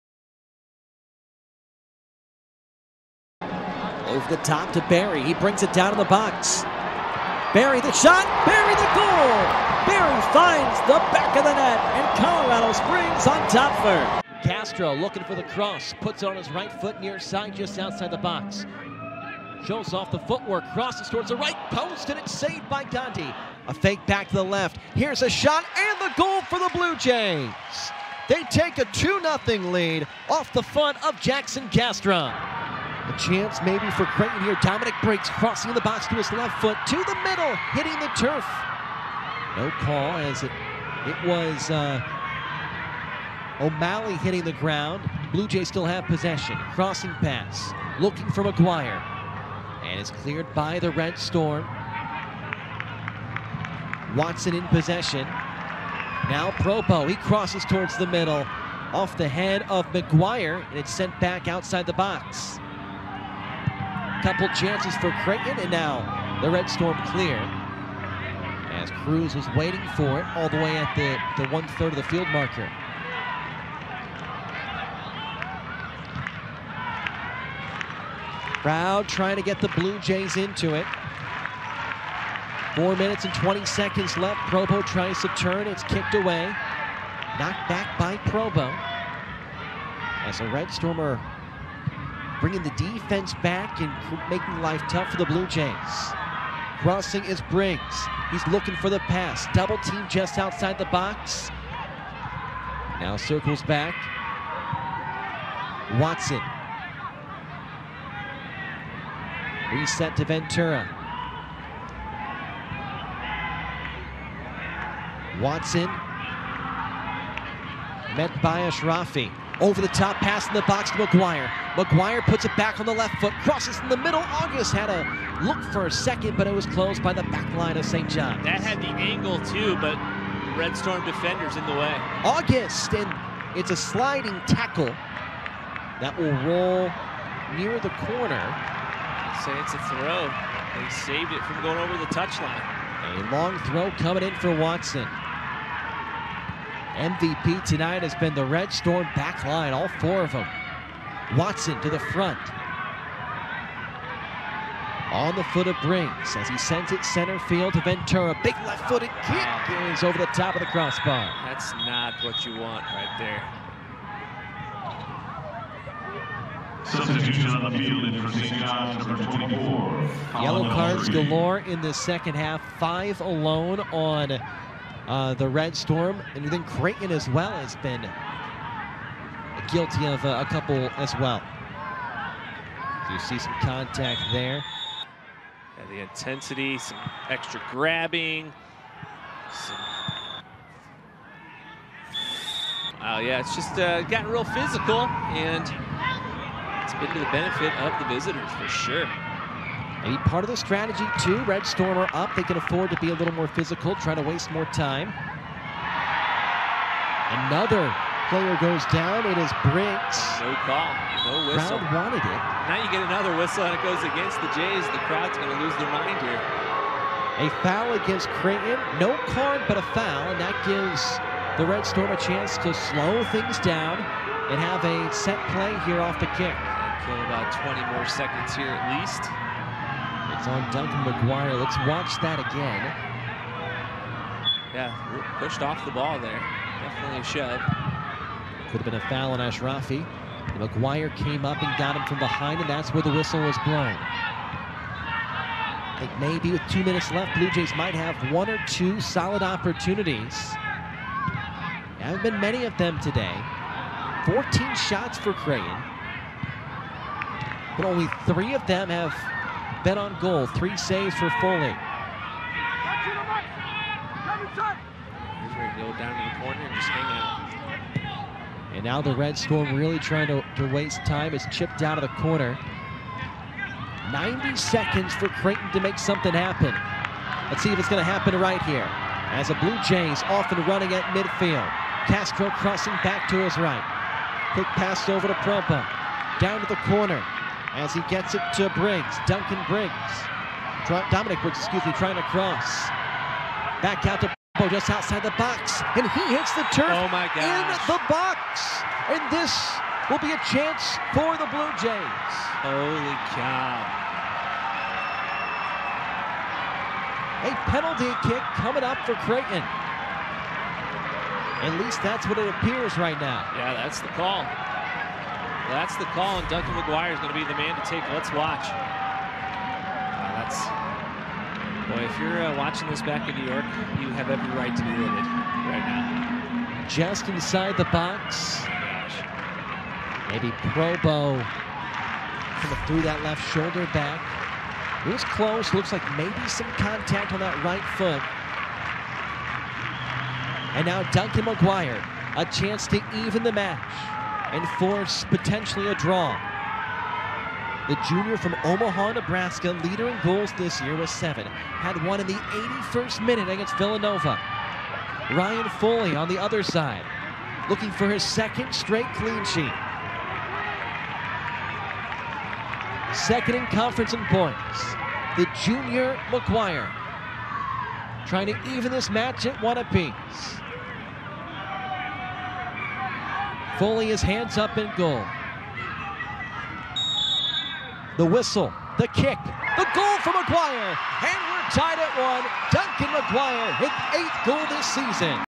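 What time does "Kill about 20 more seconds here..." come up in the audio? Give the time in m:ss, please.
3:47.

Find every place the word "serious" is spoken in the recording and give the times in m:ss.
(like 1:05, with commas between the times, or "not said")
not said.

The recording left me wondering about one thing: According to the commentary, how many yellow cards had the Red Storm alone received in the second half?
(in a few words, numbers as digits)
5.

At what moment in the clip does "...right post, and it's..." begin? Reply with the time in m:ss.
0:21.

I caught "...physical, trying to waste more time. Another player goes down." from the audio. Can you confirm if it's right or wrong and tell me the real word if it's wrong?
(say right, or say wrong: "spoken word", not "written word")
right.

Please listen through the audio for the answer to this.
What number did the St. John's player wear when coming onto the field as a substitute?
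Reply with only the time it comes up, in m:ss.
2:49.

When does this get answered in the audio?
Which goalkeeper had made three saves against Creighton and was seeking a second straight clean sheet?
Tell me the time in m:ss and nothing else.
5:55.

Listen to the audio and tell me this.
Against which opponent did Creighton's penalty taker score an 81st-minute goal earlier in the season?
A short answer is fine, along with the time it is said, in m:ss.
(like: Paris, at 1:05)
Villanova, at 5:53.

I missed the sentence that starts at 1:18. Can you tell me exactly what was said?
Crowd trying to get the Blue Jays into it.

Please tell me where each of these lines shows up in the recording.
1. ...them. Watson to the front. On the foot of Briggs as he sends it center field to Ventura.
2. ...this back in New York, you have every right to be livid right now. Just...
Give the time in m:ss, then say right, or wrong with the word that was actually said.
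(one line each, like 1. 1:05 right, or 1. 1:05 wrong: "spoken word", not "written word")
1. 2:30 right
2. 5:22 right.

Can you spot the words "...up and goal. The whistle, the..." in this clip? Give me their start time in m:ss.
6:14.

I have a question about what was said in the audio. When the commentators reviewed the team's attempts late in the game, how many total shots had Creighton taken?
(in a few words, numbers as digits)
14.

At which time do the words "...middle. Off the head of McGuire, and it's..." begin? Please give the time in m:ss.
0:58.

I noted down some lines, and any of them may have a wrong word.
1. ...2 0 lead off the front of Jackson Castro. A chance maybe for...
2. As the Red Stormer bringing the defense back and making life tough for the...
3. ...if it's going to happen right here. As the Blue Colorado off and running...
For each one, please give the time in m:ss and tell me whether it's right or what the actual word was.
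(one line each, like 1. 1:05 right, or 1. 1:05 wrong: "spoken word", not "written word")
1. 0:28 right
2. 1:30 right
3. 4:37 wrong: "Jays", not "Colorado".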